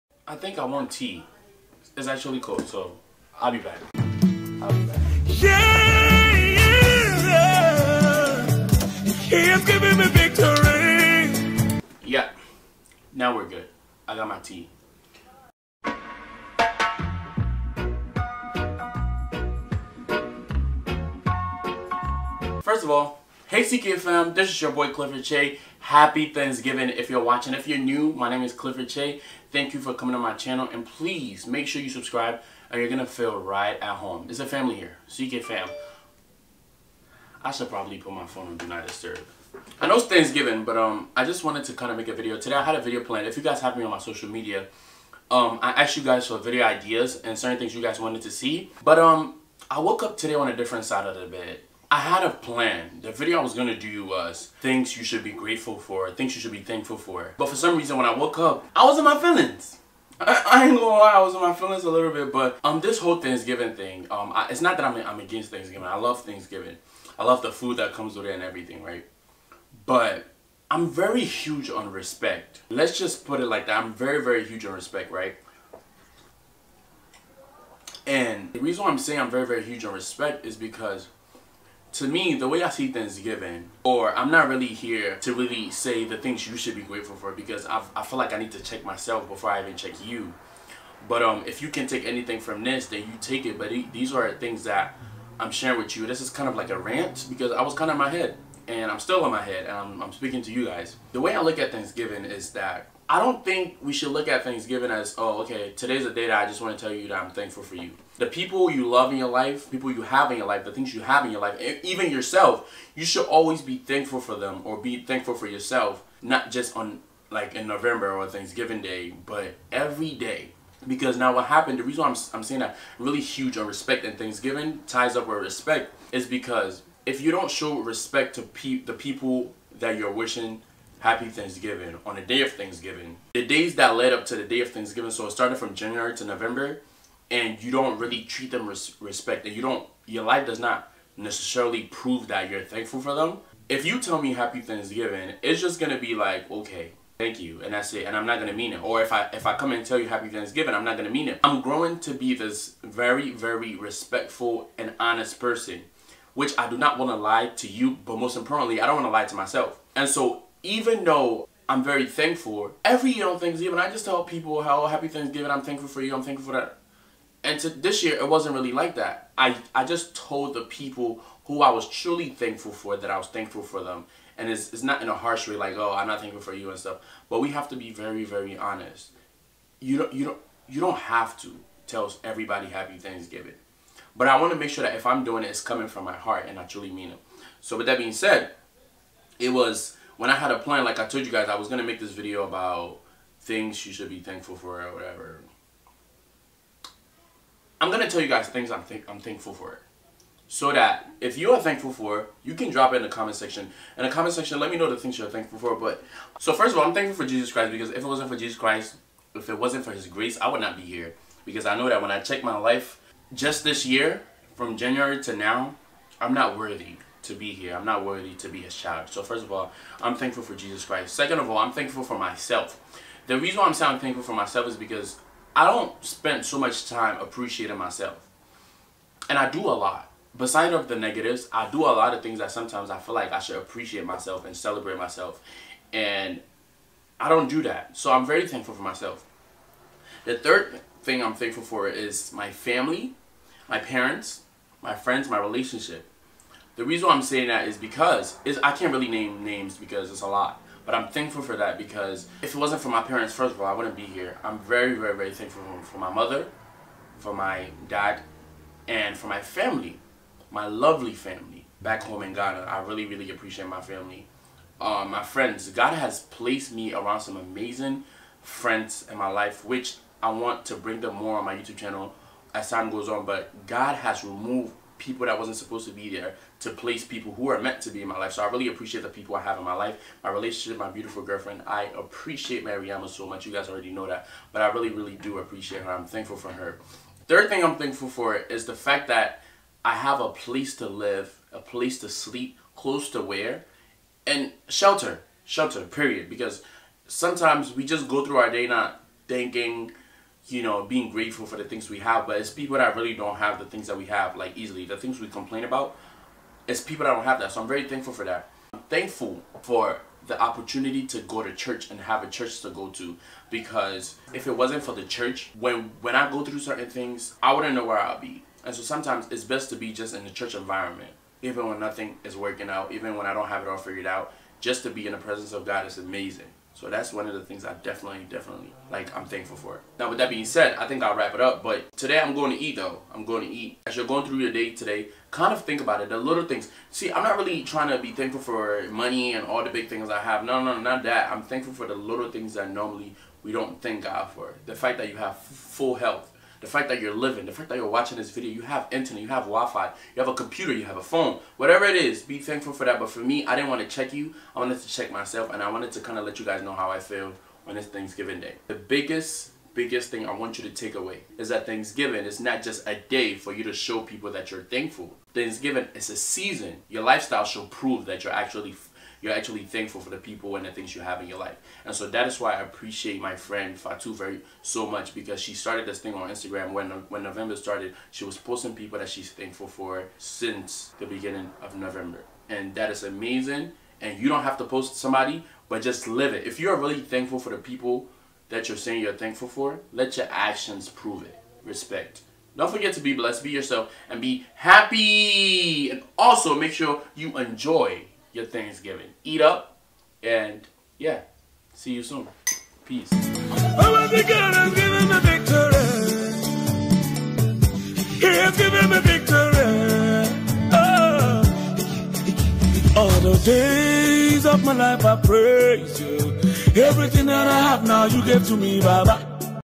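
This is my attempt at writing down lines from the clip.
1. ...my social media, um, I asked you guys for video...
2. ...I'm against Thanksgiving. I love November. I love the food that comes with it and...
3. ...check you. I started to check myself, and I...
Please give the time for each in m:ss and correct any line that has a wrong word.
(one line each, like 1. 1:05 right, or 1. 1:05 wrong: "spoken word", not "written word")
1. 0:43 right
2. 1:05 wrong: "Thanksgiving", not "November"
3. 5:53 wrong: "wanted", not "started".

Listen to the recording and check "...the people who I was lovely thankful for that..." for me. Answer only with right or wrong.
wrong.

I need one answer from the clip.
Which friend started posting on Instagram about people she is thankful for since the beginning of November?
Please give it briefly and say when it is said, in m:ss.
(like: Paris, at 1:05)
Fatu, at 6:13.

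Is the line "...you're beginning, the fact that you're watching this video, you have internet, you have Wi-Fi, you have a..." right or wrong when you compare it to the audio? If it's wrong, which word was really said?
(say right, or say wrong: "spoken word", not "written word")
wrong: "living", not "beginning".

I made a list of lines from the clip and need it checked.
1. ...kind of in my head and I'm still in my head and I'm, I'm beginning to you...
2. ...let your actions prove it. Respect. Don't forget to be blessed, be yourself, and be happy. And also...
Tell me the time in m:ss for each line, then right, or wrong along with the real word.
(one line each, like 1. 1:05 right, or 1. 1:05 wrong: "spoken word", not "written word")
1. 1:37 wrong: "speaking", not "beginning"
2. 6:29 right.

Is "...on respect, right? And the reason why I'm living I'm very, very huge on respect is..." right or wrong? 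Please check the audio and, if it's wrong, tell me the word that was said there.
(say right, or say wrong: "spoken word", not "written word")
wrong: "saying", not "living".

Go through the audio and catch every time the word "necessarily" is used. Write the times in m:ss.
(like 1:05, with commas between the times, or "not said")
2:21.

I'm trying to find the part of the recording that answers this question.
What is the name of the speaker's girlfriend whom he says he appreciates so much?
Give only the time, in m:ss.
4:42.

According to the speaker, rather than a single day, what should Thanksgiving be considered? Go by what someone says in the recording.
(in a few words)
A season.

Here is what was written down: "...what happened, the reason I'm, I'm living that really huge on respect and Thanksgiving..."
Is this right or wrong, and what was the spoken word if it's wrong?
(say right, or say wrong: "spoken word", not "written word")
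wrong: "saying", not "living".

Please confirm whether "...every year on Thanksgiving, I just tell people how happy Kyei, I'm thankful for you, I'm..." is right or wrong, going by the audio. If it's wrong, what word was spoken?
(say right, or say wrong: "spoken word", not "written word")
wrong: "Thanksgiving", not "Kyei".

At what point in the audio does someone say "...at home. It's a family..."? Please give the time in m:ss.
0:33.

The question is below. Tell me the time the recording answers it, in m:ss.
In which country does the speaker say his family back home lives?
4:22.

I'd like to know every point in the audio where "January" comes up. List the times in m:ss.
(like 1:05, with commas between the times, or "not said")
2:15, 3:34.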